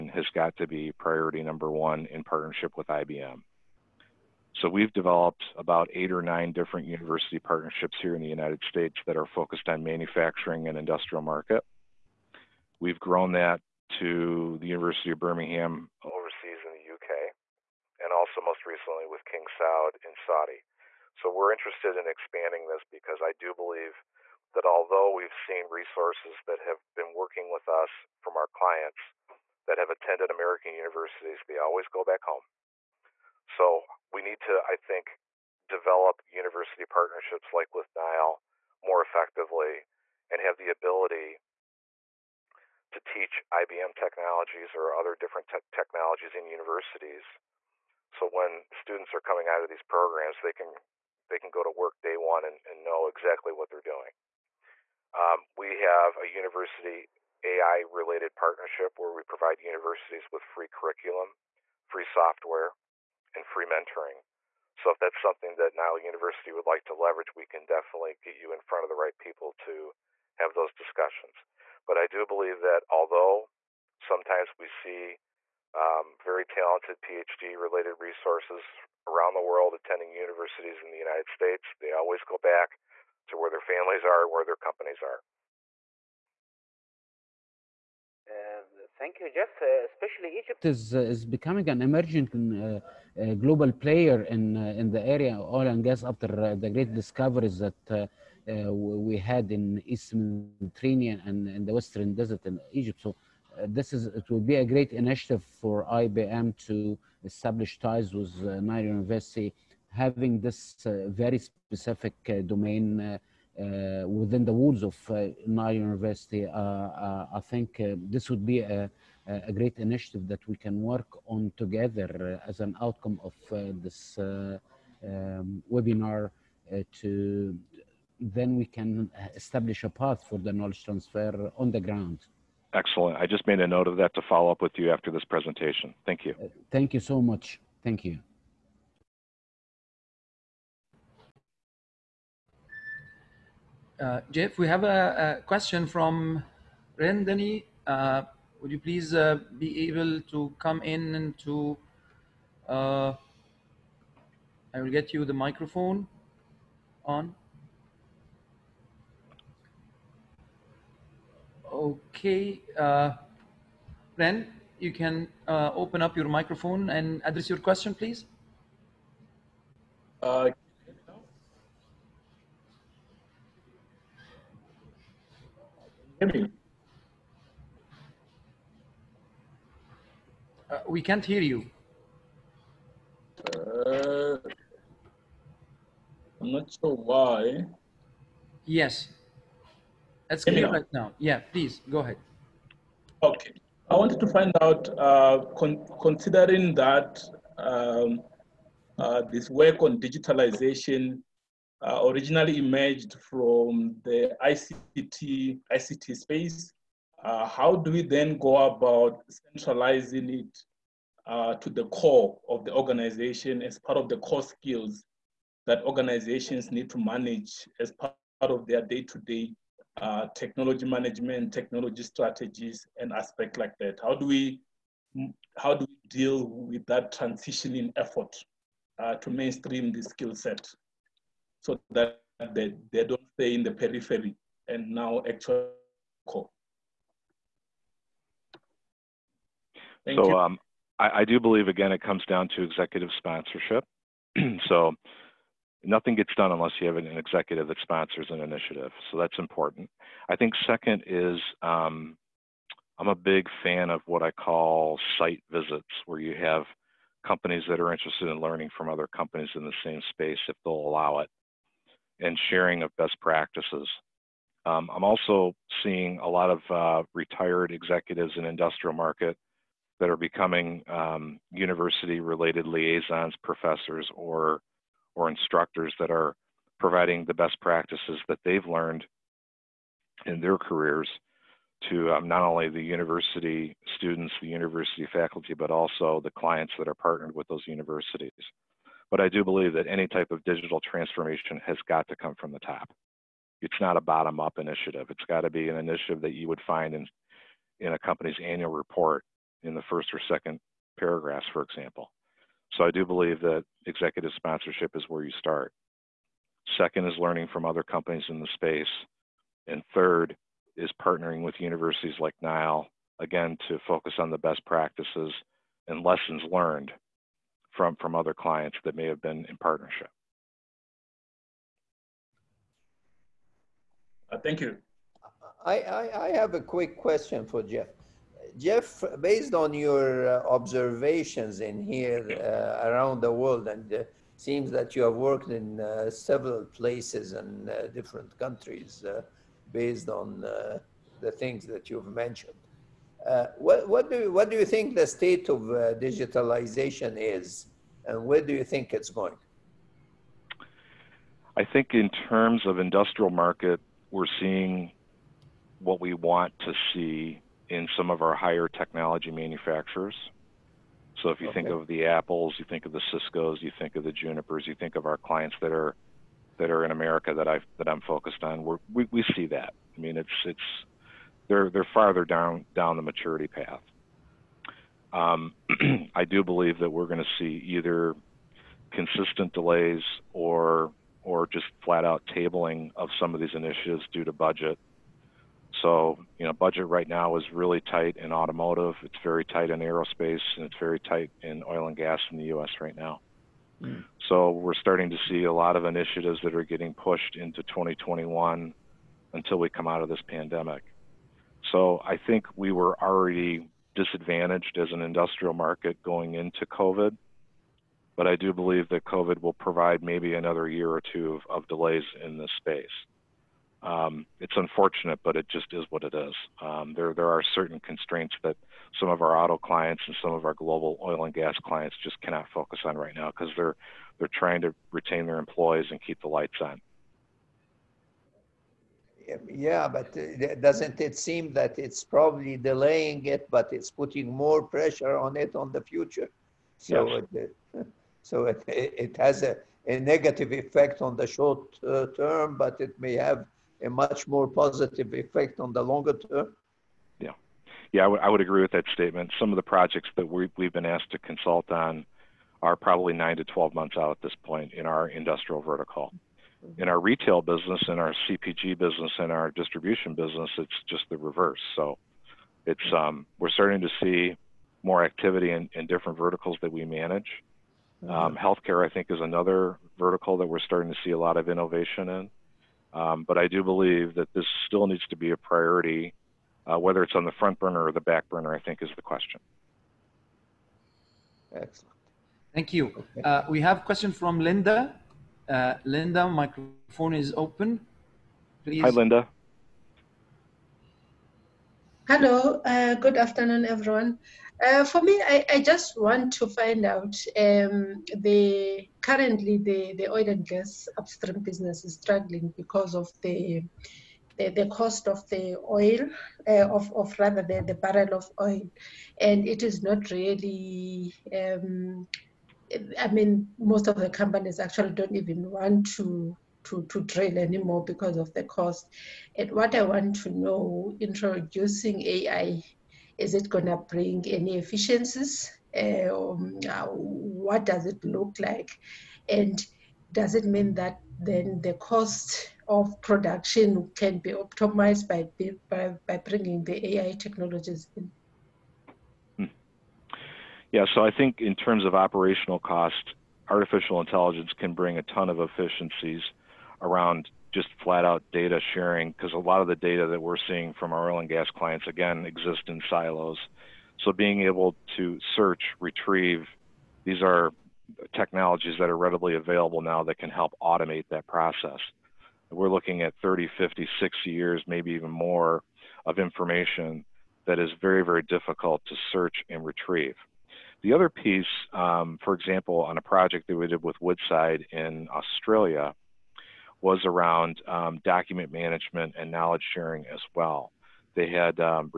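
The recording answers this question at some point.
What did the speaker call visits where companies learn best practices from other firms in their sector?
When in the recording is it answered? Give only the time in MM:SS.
04:15.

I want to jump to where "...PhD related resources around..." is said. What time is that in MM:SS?
01:17.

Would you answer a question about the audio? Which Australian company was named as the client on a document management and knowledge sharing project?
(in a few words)
Woodside.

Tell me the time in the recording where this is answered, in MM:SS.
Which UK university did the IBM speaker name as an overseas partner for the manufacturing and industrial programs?
00:14.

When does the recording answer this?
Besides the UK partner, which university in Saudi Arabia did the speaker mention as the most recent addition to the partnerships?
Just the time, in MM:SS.
00:19.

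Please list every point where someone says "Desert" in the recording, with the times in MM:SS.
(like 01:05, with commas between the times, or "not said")
01:42.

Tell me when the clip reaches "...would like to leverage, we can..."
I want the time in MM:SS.
01:06.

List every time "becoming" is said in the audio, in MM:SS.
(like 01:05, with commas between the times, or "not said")
01:31, 04:30.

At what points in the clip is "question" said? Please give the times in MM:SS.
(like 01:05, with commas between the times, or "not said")
02:25, 02:47, 05:26, 07:59, 08:03.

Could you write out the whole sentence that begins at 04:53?
It's not a bottom up initiative.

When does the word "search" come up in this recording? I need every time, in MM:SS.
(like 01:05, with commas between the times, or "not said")
09:15, 09:29.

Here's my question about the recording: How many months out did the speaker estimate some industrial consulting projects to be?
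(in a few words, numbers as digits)
9 to 12 months.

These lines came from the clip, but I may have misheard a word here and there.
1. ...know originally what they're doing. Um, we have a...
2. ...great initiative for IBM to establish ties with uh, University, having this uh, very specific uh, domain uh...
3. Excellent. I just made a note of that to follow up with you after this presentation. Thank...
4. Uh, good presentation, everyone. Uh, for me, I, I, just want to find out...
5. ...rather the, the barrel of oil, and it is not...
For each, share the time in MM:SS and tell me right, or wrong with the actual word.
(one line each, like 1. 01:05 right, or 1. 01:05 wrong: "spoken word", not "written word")
1. 00:52 wrong: "exactly", not "originally"
2. 01:44 right
3. 02:12 right
4. 08:12 wrong: "afternoon", not "presentation"
5. 08:27 right.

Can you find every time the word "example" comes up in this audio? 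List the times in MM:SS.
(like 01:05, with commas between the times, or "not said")
05:01, 09:32.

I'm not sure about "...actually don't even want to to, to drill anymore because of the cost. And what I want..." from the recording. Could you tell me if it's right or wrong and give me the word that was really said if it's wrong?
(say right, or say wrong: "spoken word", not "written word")
right.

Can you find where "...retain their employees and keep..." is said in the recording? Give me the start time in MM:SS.
07:04.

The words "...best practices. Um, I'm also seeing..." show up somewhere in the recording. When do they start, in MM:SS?
04:22.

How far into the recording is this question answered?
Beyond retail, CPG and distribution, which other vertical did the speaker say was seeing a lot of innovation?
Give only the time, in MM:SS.
07:48.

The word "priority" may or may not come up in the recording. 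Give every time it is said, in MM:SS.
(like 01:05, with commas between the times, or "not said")
00:00, 07:55.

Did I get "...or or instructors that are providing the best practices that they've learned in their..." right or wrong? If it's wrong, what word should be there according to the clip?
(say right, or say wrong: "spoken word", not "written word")
right.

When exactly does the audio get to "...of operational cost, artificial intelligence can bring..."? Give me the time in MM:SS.
09:01.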